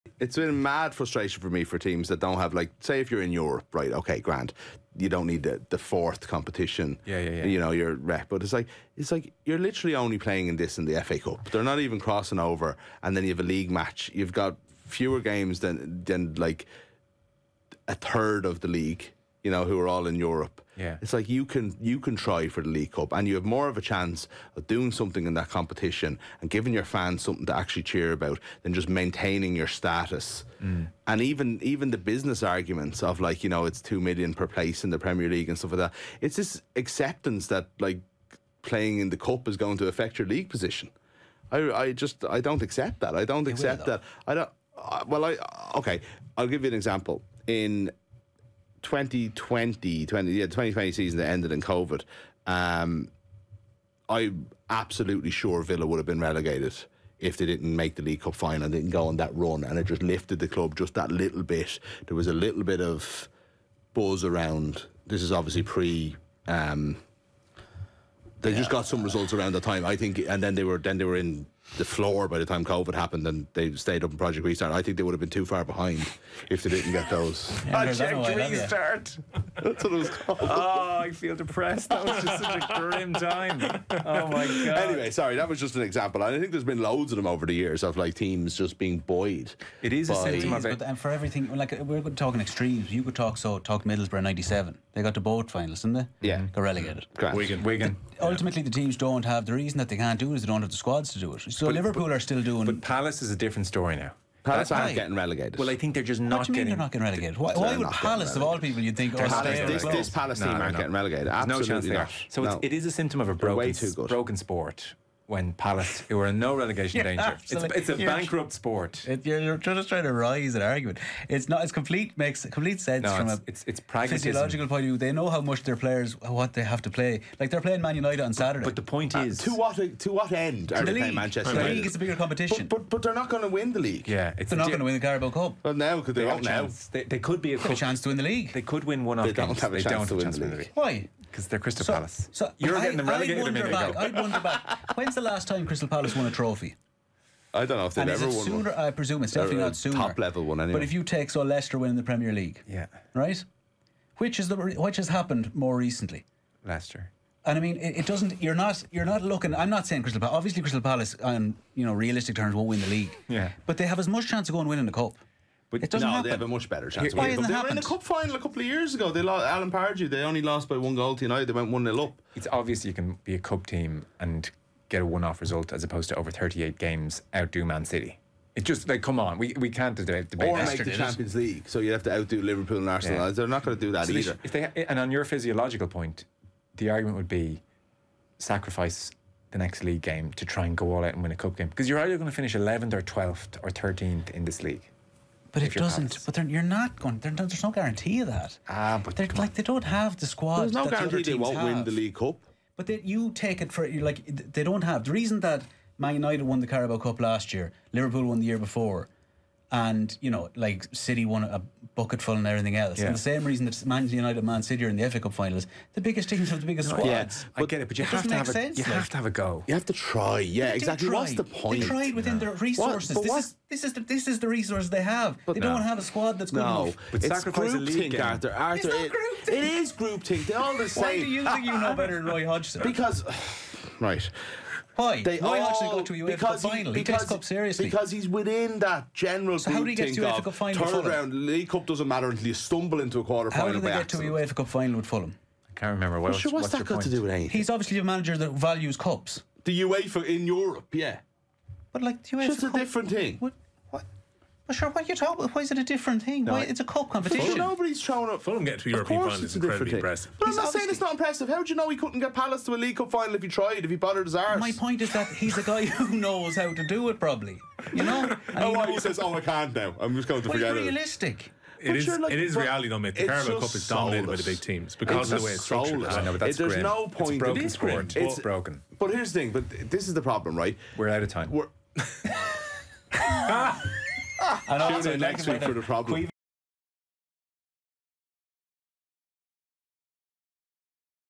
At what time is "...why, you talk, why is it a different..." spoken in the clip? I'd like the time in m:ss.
4:14.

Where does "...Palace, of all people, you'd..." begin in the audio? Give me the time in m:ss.
1:47.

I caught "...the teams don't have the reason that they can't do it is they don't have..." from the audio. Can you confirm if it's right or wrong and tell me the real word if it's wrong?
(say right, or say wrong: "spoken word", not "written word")
right.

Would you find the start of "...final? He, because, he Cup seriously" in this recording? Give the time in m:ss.
3:56.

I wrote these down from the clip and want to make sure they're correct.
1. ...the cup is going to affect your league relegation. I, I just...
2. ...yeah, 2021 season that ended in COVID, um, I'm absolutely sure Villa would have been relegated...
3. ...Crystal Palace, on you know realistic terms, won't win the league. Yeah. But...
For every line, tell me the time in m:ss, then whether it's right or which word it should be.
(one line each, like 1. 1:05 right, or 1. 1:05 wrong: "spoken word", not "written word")
1. 0:39 wrong: "position", not "relegation"
2. 0:50 wrong: "2020", not "2021"
3. 2:40 right.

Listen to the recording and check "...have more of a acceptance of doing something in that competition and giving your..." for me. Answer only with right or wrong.
wrong.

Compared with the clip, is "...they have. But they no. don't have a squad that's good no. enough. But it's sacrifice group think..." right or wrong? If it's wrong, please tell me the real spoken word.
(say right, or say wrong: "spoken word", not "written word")
right.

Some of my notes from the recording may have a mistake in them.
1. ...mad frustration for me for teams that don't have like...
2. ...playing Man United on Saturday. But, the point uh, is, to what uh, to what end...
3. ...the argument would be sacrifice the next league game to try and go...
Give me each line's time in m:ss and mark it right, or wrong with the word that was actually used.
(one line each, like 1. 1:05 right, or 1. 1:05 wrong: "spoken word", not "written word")
1. 0:00 right
2. 2:07 right
3. 3:06 right.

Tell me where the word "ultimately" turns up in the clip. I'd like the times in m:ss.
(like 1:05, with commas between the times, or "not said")
1:38.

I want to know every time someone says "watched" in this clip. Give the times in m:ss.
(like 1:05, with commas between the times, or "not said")
not said.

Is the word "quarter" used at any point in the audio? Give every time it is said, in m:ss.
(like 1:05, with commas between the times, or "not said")
4:03.